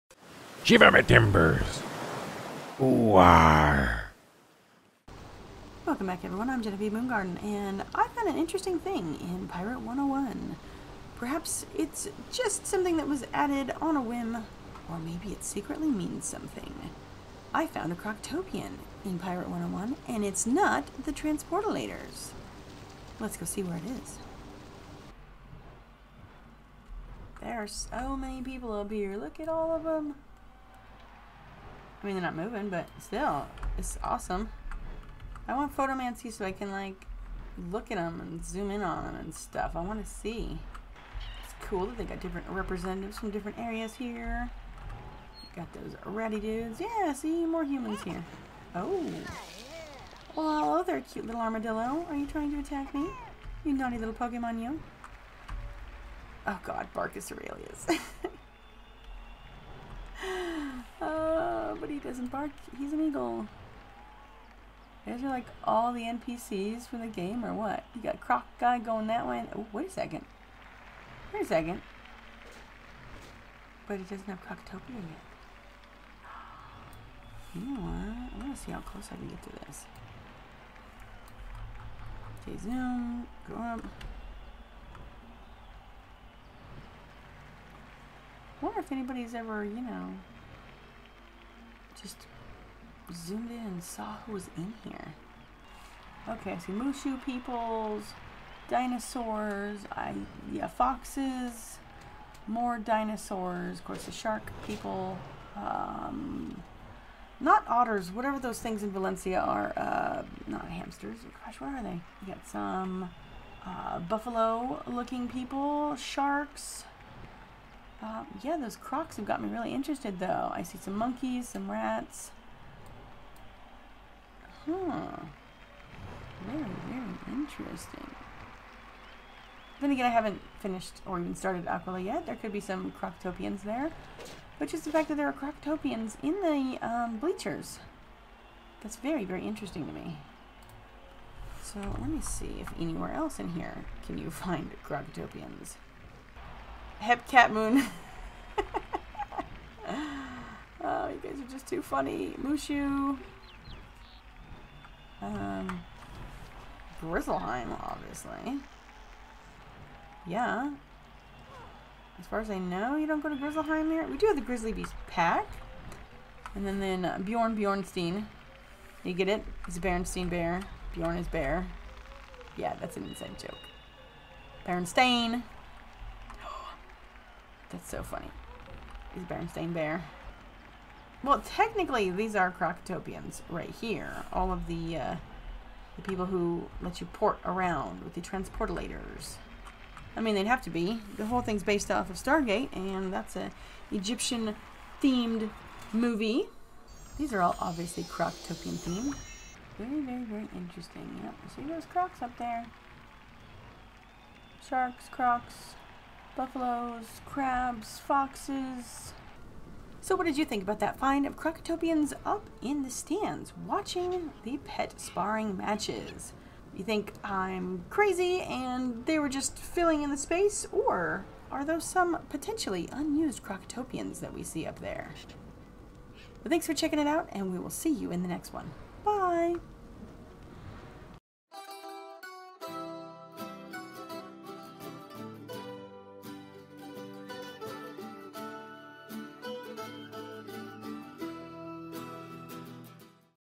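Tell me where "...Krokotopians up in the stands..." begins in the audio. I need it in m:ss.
3:31.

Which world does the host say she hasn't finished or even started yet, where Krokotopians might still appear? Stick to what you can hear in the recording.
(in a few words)
Aquila.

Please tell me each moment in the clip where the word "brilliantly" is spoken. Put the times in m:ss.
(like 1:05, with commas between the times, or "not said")
not said.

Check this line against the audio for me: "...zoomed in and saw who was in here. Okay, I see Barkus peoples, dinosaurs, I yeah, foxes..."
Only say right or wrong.
wrong.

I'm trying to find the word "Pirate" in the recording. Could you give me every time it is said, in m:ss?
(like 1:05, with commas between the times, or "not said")
0:09, 0:19.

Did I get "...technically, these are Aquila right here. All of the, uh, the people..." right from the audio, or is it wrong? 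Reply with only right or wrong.
wrong.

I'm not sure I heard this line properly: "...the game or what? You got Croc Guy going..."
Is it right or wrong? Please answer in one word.
right.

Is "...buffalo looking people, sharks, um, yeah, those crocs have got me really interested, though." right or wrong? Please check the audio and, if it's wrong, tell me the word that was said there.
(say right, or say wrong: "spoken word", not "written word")
right.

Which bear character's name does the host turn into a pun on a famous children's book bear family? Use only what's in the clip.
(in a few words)
Bjorn Bjornstein.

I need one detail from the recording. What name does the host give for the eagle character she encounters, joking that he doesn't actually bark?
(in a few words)
Barkus Aurelius.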